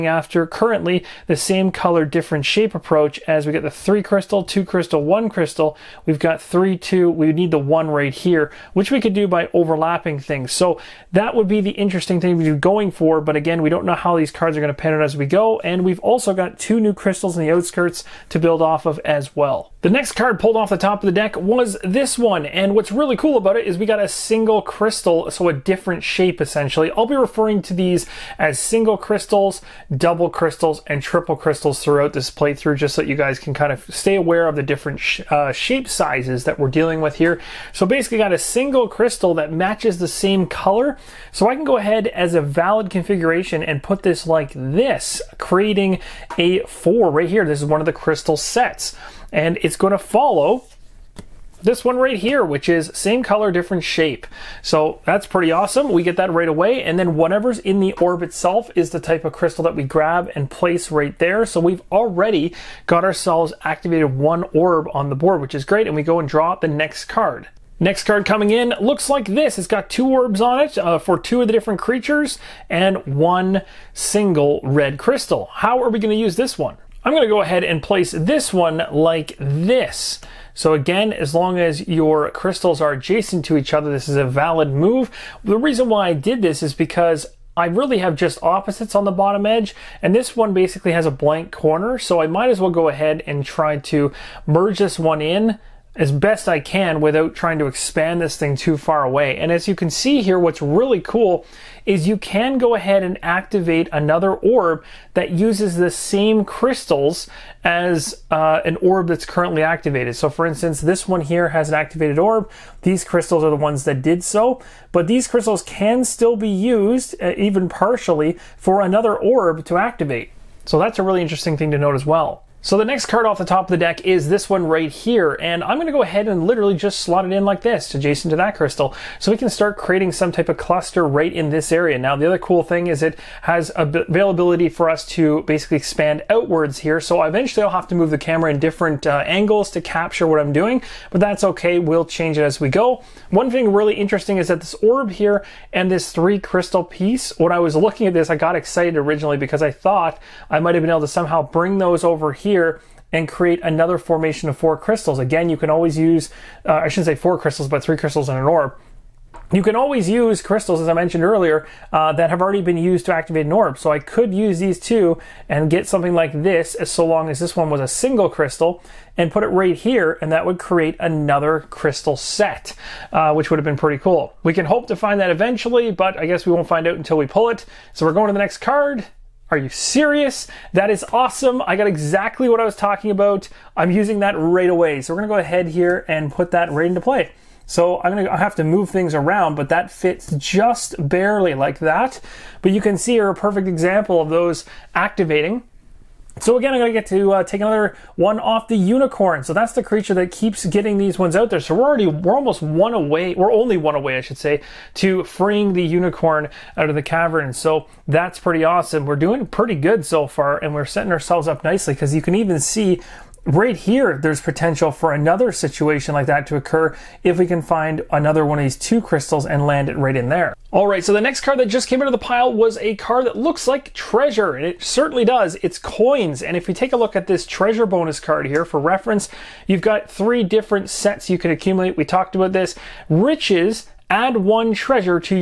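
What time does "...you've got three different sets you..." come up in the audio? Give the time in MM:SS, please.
03:49.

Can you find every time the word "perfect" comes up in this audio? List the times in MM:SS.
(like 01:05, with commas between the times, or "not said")
03:13.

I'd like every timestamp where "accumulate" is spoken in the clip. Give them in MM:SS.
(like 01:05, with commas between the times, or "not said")
03:51.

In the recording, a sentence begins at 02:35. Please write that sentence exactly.
Again, you can always use, uh, I shouldn't say four crystals, but three crystals in an orb.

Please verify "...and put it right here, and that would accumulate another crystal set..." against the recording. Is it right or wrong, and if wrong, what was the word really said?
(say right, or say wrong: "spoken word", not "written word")
wrong: "create", not "accumulate".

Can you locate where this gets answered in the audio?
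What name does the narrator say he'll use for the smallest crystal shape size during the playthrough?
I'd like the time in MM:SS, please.
00:28.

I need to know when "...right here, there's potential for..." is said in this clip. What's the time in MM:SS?
03:33.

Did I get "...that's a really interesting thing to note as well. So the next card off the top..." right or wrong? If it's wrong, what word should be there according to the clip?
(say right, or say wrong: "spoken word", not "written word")
right.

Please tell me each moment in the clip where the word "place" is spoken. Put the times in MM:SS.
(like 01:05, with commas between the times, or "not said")
01:00, 01:17.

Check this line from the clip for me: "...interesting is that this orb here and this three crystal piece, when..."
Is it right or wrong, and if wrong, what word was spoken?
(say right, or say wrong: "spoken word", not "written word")
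right.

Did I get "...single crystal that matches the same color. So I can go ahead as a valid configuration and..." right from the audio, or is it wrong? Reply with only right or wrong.
right.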